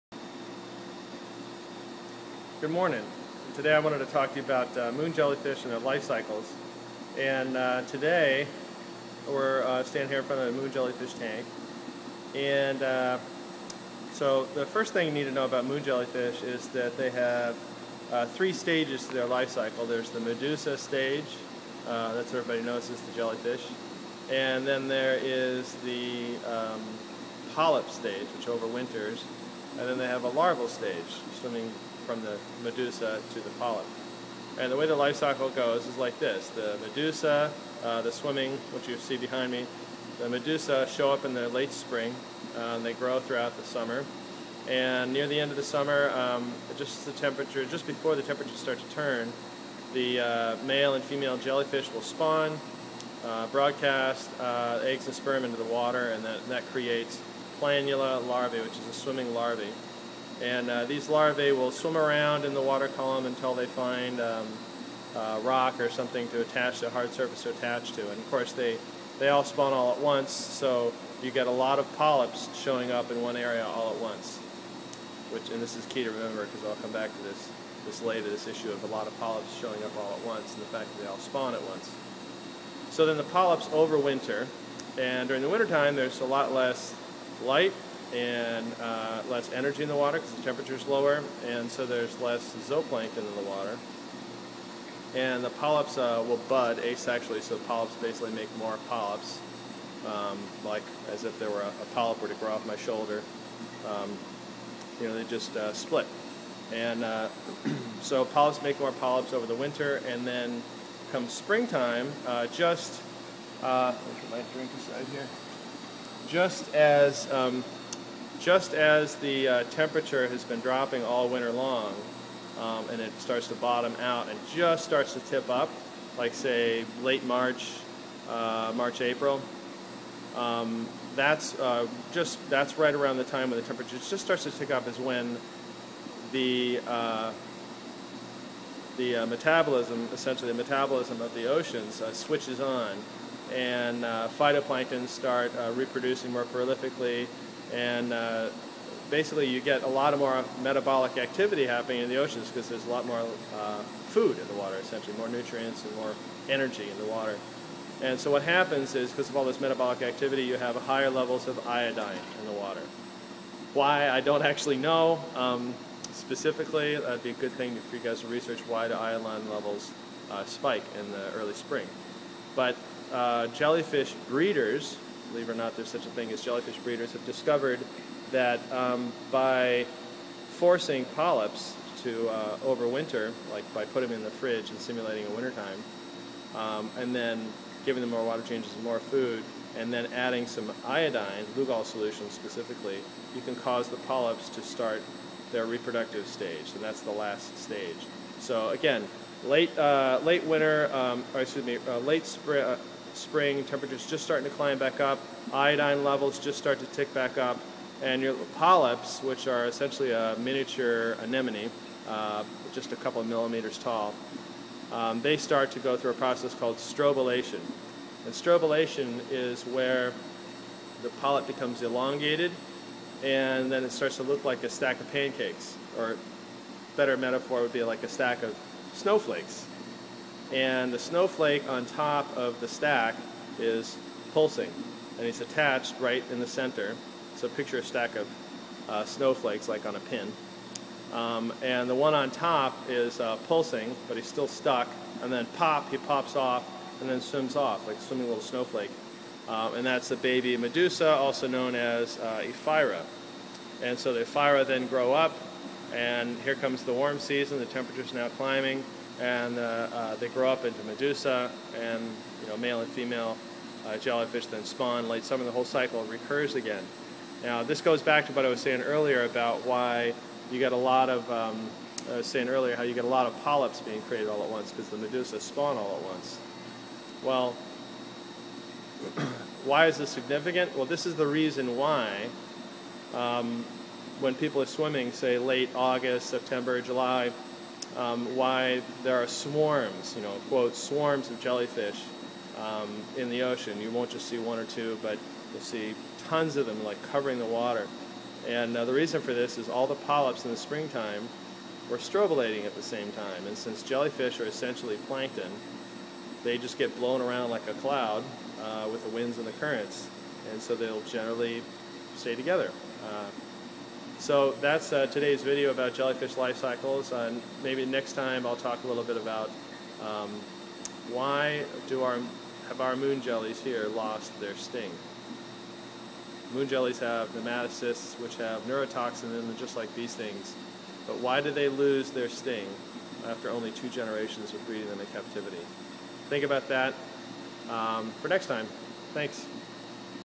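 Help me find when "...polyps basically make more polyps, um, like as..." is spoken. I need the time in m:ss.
1:37.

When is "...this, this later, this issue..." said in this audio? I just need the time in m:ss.
1:17.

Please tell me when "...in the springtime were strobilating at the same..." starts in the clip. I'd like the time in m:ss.
5:00.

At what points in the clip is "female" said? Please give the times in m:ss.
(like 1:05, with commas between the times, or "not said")
0:51, 4:22.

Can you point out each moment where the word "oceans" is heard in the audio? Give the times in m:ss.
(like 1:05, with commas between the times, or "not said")
2:21, 2:32, 4:53.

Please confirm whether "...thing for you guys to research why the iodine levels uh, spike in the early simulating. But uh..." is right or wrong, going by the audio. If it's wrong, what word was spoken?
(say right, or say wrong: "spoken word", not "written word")
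wrong: "spring", not "simulating".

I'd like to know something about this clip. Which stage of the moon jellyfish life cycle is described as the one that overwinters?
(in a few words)
polyp stage.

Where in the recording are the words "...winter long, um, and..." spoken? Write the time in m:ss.
2:01.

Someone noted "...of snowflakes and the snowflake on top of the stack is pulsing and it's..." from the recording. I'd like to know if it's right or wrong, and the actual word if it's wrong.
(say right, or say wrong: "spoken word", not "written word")
right.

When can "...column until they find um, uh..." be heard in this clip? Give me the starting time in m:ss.
1:02.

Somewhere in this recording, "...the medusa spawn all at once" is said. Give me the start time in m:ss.
4:34.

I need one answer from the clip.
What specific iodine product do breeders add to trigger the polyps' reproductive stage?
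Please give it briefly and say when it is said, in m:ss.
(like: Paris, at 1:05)
Lugol solution, at 3:11.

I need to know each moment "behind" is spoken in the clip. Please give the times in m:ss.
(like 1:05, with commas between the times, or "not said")
0:39.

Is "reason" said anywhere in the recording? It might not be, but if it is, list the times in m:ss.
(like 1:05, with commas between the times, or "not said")
4:41, 4:58.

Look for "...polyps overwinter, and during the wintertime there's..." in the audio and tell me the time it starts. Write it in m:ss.
1:23.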